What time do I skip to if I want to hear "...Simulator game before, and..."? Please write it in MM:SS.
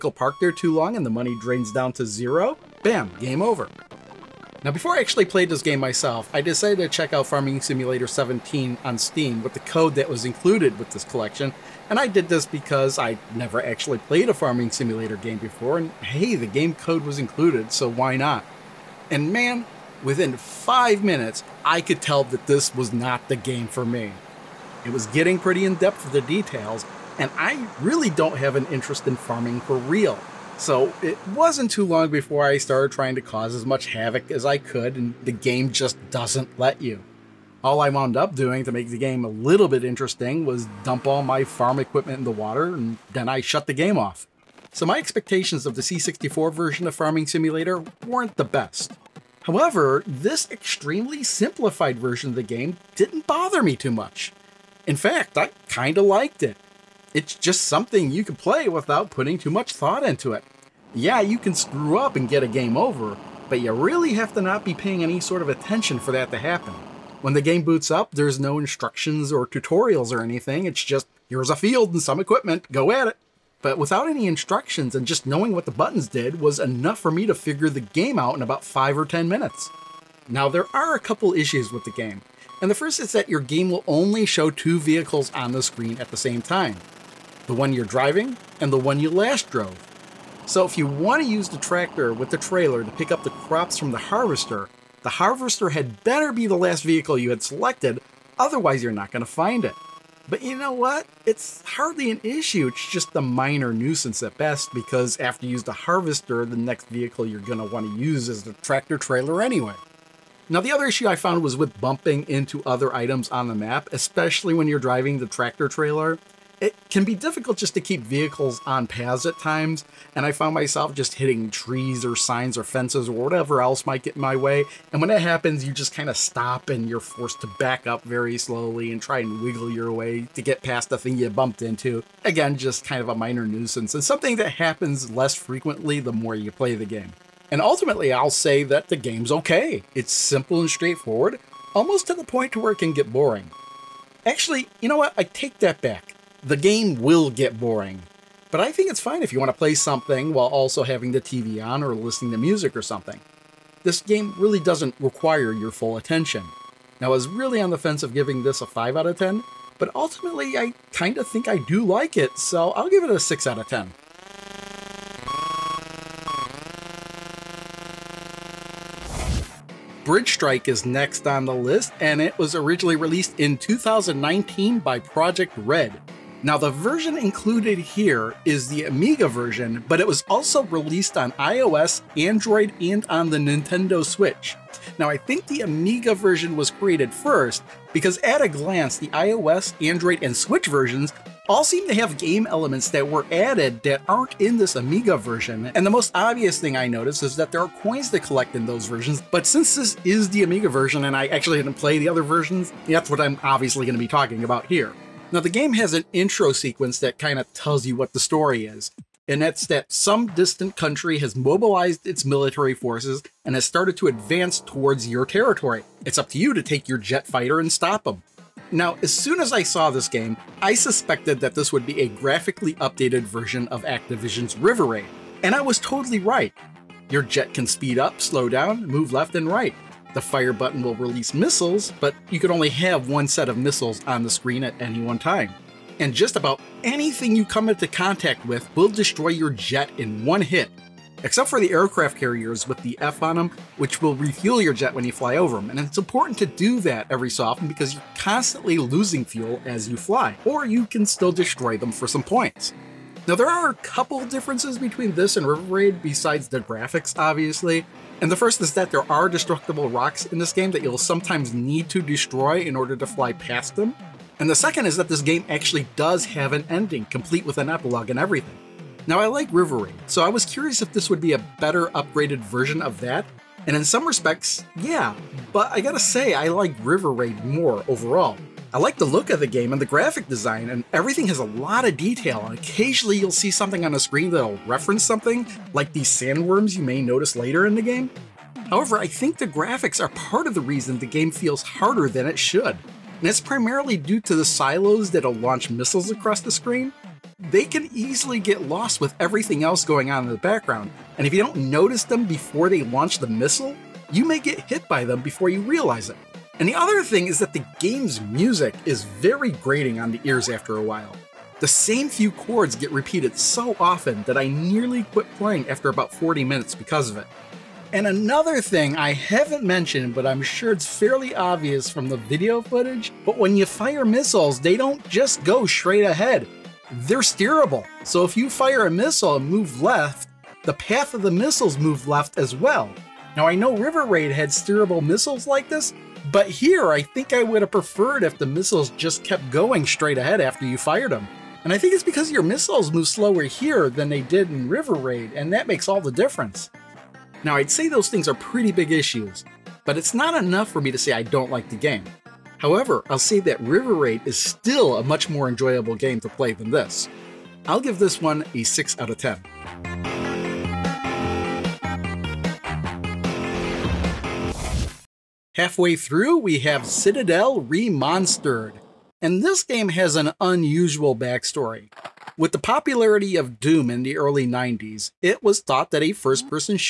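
00:14.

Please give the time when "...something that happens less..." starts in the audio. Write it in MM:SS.
02:14.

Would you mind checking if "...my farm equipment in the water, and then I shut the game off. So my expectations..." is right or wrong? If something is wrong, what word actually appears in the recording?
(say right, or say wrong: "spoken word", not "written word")
right.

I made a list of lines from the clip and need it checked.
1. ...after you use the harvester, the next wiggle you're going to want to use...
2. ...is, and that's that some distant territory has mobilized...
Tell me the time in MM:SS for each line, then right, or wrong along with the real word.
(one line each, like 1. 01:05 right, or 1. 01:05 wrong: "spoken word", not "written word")
1. 01:45 wrong: "vehicle", not "wiggle"
2. 03:28 wrong: "country", not "territory".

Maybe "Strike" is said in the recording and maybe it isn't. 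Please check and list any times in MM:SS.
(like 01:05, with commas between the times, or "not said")
02:50.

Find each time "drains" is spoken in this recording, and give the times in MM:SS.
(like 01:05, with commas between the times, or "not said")
00:01.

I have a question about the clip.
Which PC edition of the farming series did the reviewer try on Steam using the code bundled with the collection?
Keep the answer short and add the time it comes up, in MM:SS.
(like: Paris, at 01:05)
Farming Simulator 17, at 00:07.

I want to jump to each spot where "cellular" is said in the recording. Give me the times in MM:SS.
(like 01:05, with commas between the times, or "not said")
not said.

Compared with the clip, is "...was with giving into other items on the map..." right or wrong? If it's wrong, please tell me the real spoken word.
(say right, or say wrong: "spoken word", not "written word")
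wrong: "bumping", not "giving".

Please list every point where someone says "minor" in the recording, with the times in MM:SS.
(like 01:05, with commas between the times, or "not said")
01:43, 02:13.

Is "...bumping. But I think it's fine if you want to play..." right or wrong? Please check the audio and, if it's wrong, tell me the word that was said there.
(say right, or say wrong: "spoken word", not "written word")
wrong: "boring", not "bumping".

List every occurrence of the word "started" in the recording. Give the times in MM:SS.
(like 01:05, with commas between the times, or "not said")
00:32, 03:33.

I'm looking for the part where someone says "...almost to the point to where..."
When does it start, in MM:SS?
02:21.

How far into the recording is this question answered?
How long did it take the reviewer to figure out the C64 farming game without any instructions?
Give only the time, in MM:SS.
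01:18.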